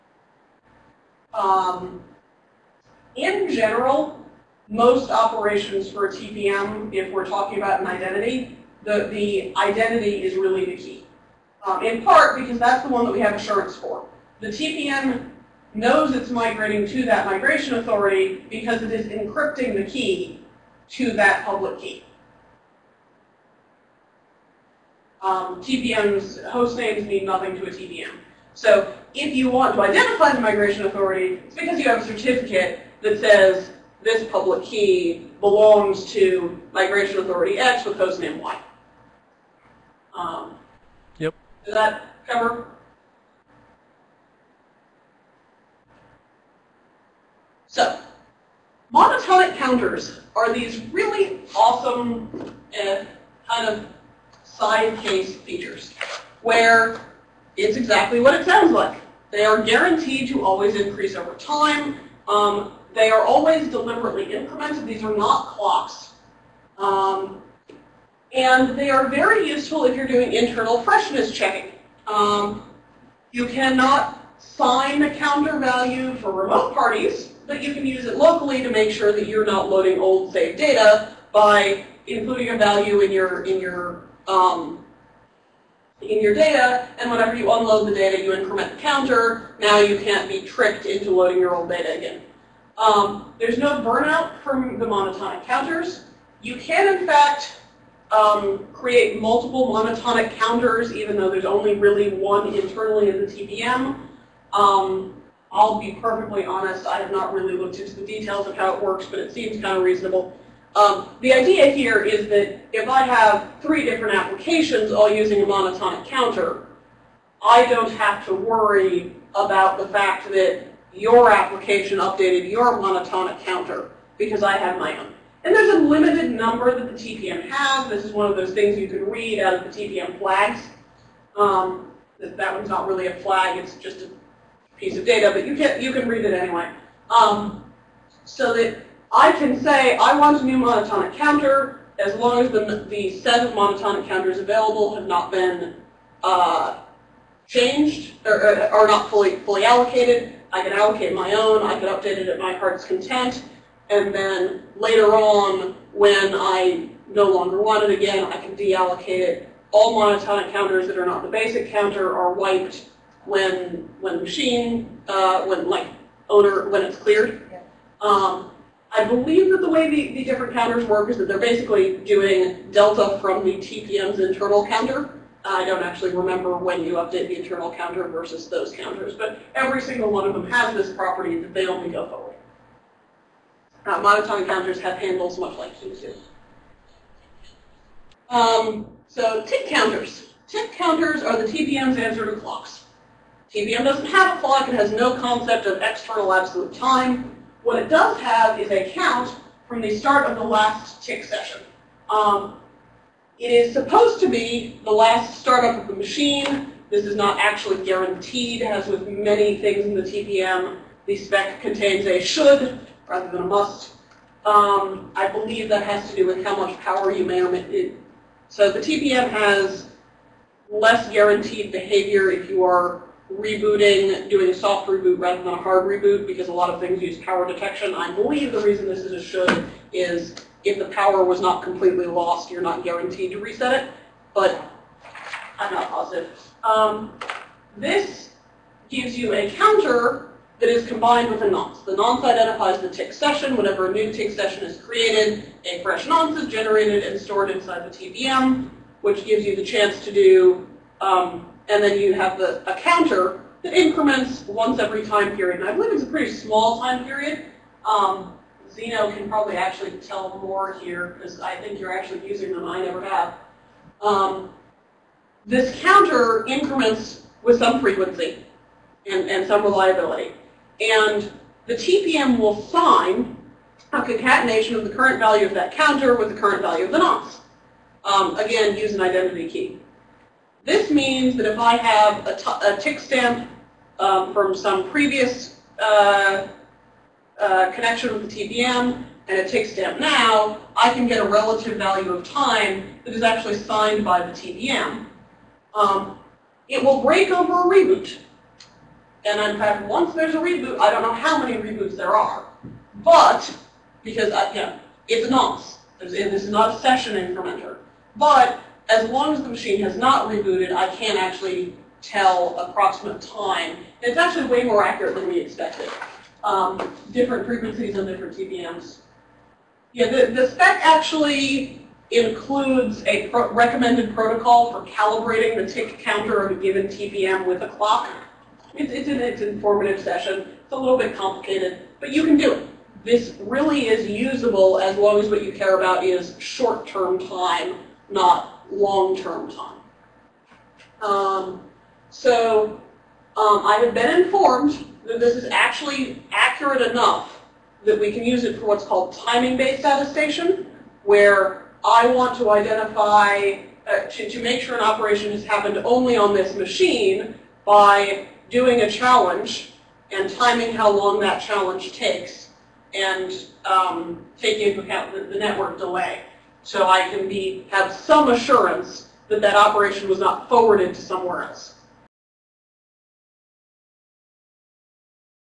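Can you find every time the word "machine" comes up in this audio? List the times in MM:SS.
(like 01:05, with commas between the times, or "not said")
02:44, 03:25, 05:09, 05:56.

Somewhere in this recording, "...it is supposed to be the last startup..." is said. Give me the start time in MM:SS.
03:23.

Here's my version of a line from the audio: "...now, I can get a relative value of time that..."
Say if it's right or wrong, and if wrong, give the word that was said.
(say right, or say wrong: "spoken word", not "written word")
right.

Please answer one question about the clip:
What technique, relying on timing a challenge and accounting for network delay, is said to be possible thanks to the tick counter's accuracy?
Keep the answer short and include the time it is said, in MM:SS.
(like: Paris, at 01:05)
timing-based attestation, at 05:49.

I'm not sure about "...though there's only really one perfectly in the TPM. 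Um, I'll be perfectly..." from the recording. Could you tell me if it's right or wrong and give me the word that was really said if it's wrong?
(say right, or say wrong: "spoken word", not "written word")
wrong: "internally", not "perfectly".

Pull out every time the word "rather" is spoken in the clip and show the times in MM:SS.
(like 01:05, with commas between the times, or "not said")
03:33, 03:45.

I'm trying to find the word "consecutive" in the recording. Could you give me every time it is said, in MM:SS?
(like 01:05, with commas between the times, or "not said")
not said.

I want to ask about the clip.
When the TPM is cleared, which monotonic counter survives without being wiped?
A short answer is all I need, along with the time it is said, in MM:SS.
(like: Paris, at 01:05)
the basic counter, at 02:41.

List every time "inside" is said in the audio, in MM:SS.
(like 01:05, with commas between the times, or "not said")
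04:07.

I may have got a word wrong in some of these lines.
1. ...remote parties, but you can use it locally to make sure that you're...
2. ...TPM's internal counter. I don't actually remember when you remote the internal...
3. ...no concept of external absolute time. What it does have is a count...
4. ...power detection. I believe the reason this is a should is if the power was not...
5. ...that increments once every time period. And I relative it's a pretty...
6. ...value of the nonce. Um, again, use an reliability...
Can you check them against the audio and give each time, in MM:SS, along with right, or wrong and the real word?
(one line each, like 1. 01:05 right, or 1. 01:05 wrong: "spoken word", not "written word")
1. 01:16 right
2. 02:53 wrong: "update", not "remote"
3. 03:14 right
4. 03:47 right
5. 04:13 wrong: "believe", not "relative"
6. 04:36 wrong: "identity", not "reliability".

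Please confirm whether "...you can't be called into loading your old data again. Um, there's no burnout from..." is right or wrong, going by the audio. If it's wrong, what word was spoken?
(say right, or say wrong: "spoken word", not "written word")
wrong: "tricked", not "called".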